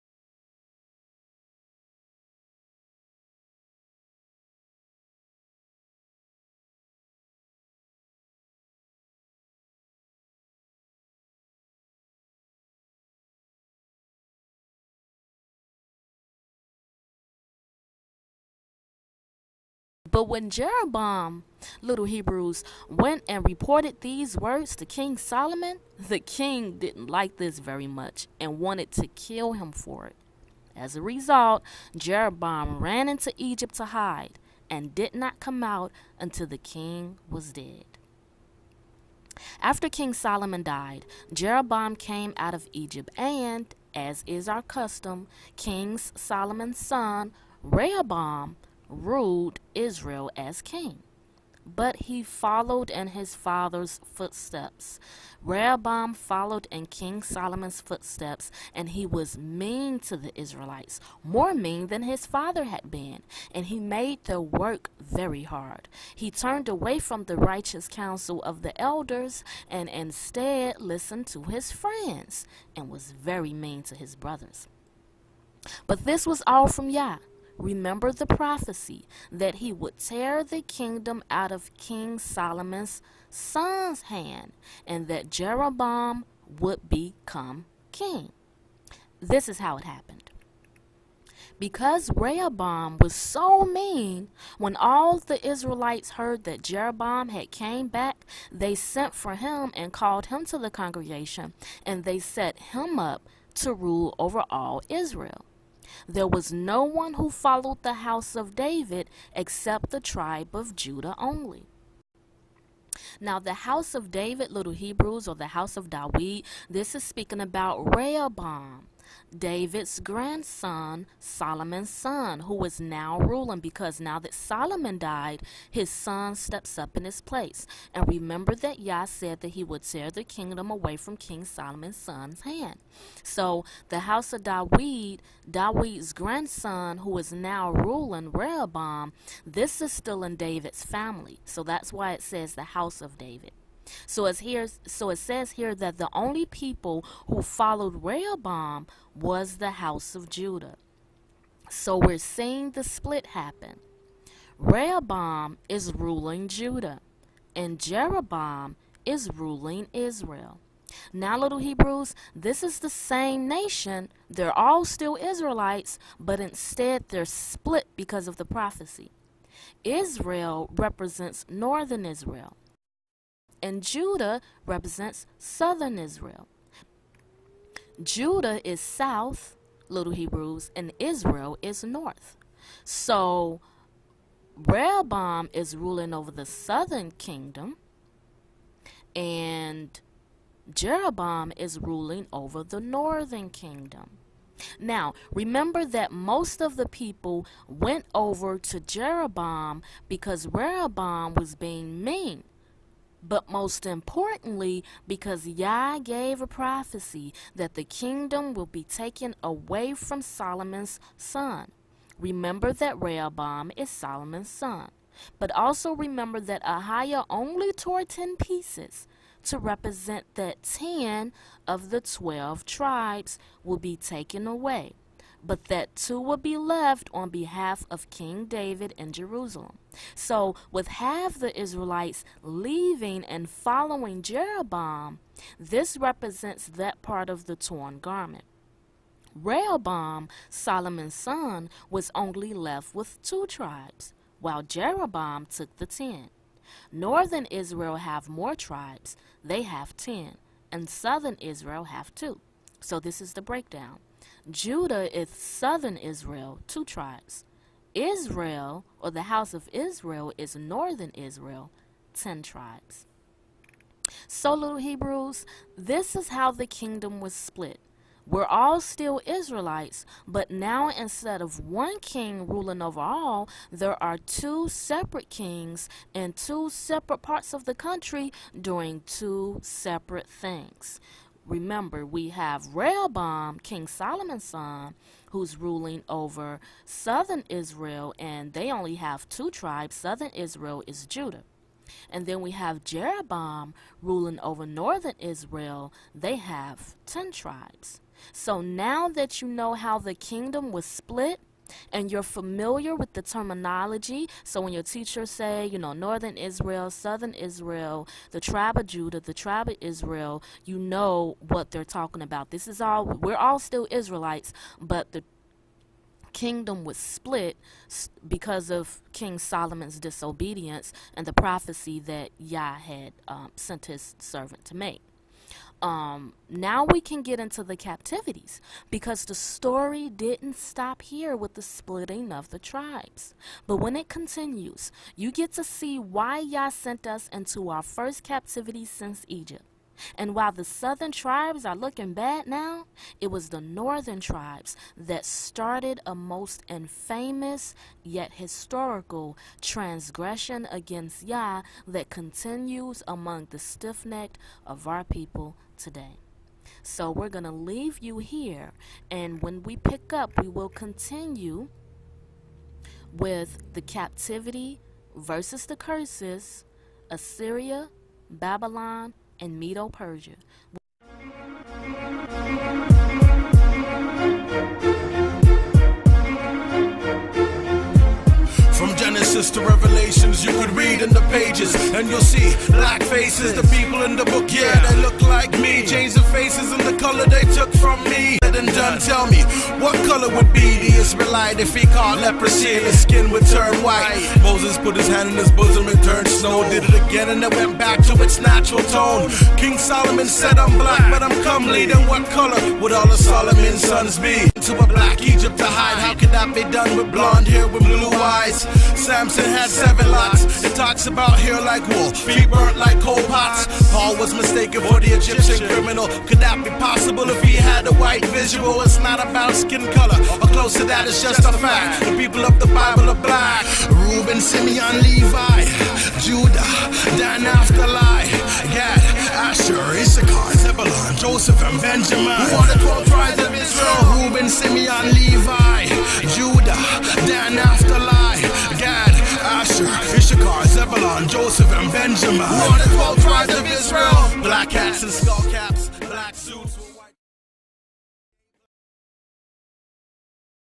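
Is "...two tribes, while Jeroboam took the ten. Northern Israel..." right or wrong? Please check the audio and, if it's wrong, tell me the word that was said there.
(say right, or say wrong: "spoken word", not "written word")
right.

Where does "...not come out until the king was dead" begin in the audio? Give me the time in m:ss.
0:35.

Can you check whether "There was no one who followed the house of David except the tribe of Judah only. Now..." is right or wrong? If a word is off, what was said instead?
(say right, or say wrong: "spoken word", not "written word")
right.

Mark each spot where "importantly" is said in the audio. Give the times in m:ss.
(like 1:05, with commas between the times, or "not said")
3:23.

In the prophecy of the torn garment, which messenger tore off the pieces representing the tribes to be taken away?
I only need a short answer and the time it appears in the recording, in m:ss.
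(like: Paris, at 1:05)
Ahiah, at 3:36.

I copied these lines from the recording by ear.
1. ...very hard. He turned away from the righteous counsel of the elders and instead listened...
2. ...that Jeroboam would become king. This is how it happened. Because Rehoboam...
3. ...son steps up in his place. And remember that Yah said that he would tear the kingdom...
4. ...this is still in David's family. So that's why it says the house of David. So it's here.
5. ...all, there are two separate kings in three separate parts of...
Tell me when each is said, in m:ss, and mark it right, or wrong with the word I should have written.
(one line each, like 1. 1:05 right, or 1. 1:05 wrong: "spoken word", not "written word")
1. 1:04 right
2. 1:25 right
3. 2:05 right
4. 2:19 right
5. 4:32 wrong: "two", not "three".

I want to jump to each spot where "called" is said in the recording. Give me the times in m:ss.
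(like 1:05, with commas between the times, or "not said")
1:39.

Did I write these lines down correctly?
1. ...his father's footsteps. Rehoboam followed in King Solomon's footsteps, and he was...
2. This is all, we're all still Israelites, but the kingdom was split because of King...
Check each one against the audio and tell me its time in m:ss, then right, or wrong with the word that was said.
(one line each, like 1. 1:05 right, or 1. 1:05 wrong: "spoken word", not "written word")
1. 0:53 right
2. 5:12 right.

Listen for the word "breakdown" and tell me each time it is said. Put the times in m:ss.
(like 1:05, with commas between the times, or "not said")
4:13.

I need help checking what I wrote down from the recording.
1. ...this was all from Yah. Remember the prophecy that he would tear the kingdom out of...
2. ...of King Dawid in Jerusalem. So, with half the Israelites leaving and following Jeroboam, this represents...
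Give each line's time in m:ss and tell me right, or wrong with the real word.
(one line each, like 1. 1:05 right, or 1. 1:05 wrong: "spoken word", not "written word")
1. 1:16 right
2. 3:47 wrong: "David", not "Dawid".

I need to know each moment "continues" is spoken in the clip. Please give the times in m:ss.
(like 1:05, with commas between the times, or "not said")
5:34, 5:52, 6:00.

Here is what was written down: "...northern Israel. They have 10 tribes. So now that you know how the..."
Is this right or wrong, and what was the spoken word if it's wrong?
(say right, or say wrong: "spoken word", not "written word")
right.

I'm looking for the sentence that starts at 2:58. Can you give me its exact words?
Judah is south, little Hebrews, and Israel is north.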